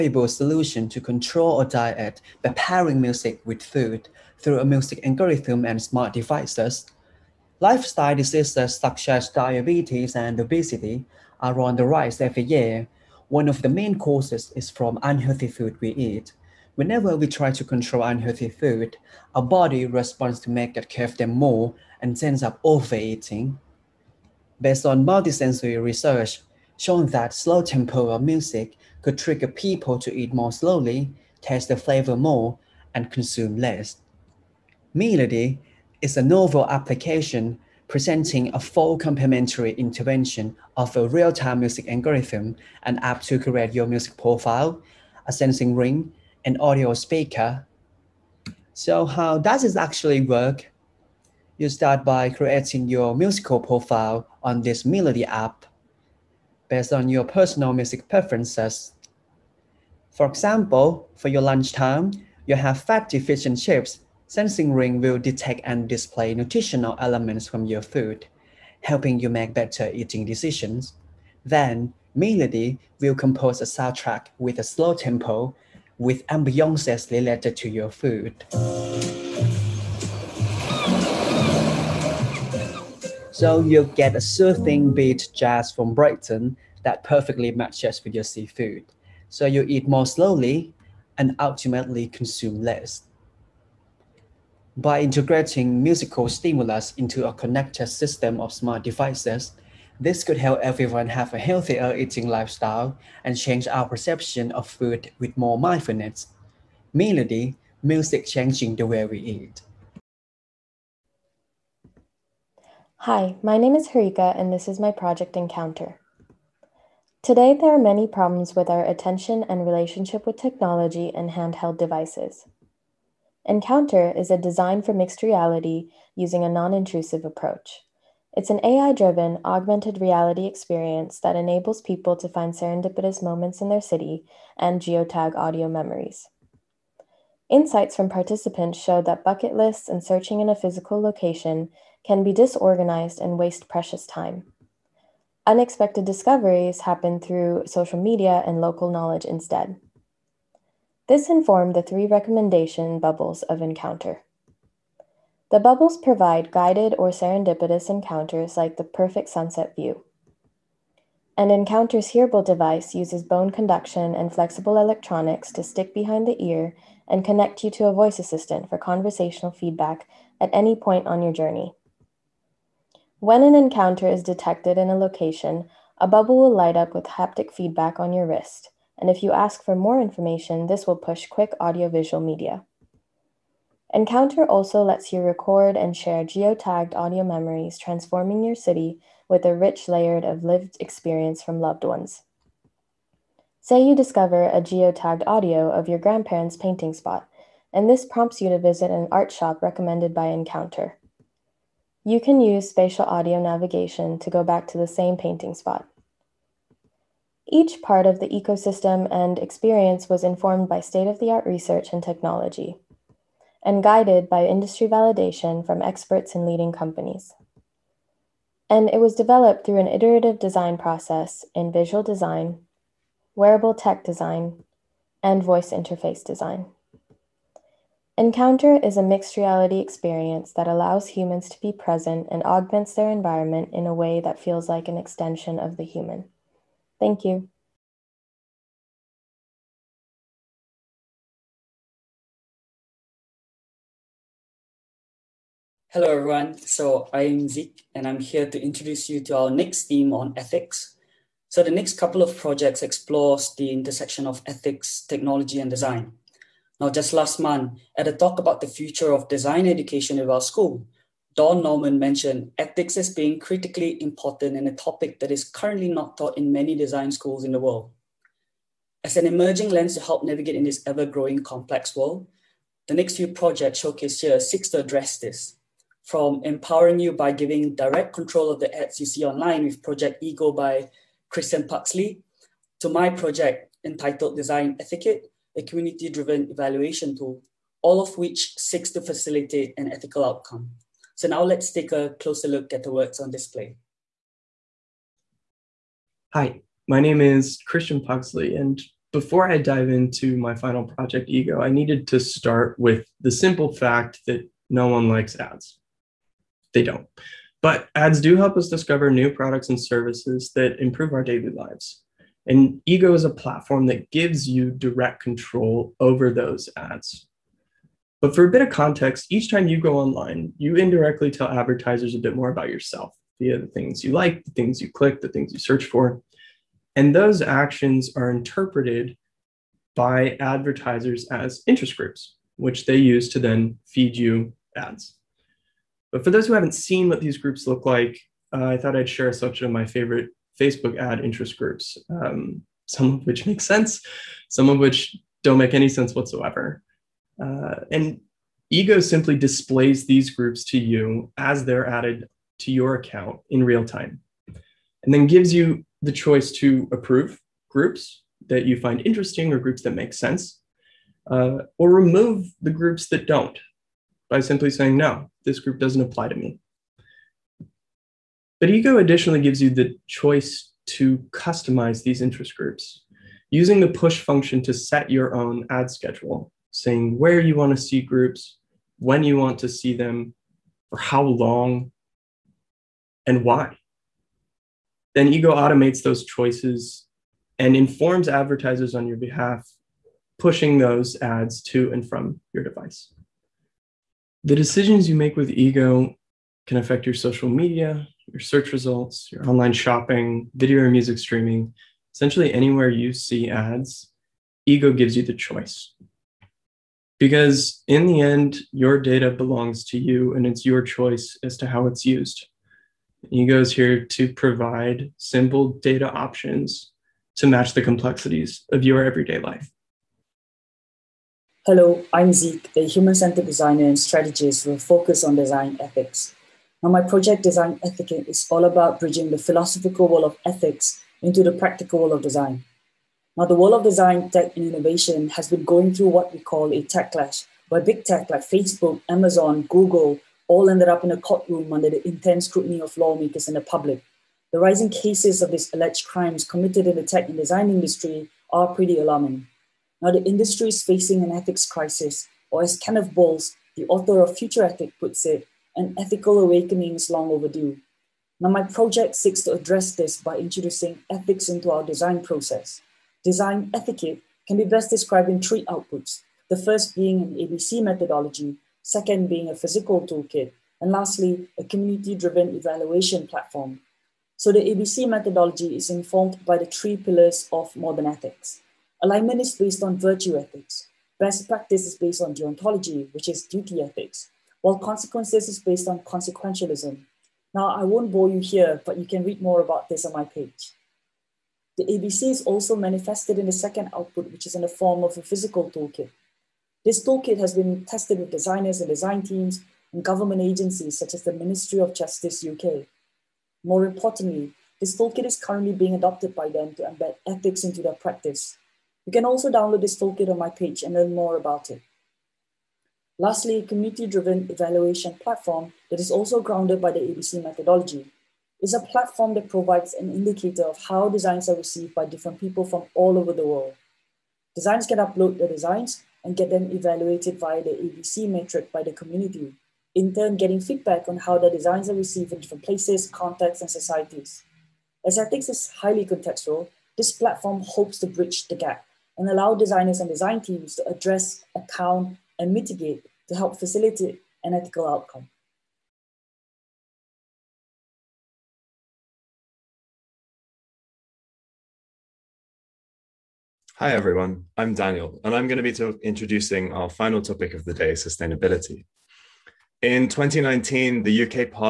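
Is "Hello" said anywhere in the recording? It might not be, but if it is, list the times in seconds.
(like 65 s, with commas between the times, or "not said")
245 s, 421 s.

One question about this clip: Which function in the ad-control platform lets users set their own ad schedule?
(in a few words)
Push function.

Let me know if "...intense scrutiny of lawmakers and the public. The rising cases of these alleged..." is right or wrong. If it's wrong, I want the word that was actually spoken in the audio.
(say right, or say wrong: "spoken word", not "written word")
right.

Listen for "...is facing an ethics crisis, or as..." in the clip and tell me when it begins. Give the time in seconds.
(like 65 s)
450 s.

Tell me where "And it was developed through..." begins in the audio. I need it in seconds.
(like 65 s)
218 s.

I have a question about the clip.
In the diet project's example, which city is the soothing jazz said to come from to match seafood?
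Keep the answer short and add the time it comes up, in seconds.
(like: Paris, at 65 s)
Brighton, at 85 s.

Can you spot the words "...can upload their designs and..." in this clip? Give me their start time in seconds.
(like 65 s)
524 s.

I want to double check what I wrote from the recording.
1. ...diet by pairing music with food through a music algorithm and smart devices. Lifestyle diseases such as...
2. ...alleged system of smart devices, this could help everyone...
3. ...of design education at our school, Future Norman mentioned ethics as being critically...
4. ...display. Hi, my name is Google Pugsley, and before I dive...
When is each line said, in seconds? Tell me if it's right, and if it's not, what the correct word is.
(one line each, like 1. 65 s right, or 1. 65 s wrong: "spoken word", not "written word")
1. 1 s right
2. 97 s wrong: "connected", not "alleged"
3. 259 s wrong: "Don", not "Future"
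4. 293 s wrong: "Christian", not "Google".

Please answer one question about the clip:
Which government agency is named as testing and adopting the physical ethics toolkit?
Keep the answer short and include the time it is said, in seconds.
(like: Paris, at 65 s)
Ministry of Justice UK, at 501 s.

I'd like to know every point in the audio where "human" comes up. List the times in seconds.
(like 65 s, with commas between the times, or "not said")
231 s, 235 s, 422 s.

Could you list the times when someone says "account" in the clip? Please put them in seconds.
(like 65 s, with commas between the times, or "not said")
352 s, 541 s.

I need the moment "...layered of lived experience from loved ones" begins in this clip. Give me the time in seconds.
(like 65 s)
189 s.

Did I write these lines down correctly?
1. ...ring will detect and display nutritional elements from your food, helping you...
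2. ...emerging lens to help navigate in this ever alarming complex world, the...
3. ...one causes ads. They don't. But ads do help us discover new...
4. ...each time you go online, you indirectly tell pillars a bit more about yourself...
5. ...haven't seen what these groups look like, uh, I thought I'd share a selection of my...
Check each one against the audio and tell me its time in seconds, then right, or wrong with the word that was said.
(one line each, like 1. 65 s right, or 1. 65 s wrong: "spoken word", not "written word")
1. 64 s right
2. 269 s wrong: "growing", not "alarming"
3. 304 s wrong: "likes", not "causes"
4. 319 s wrong: "advertisers", not "pillars"
5. 336 s right.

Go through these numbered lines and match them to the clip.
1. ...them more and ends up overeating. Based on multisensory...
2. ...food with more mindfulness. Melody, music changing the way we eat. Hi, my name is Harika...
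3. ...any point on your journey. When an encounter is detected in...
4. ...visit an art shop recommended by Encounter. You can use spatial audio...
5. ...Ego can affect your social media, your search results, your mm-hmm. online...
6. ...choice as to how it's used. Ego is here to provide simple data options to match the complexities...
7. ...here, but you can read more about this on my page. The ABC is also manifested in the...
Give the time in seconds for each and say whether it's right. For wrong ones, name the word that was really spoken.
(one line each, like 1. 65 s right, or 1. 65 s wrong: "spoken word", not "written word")
1. 21 s right
2. 104 s right
3. 170 s right
4. 198 s right
5. 395 s right
6. 410 s right
7. 488 s right.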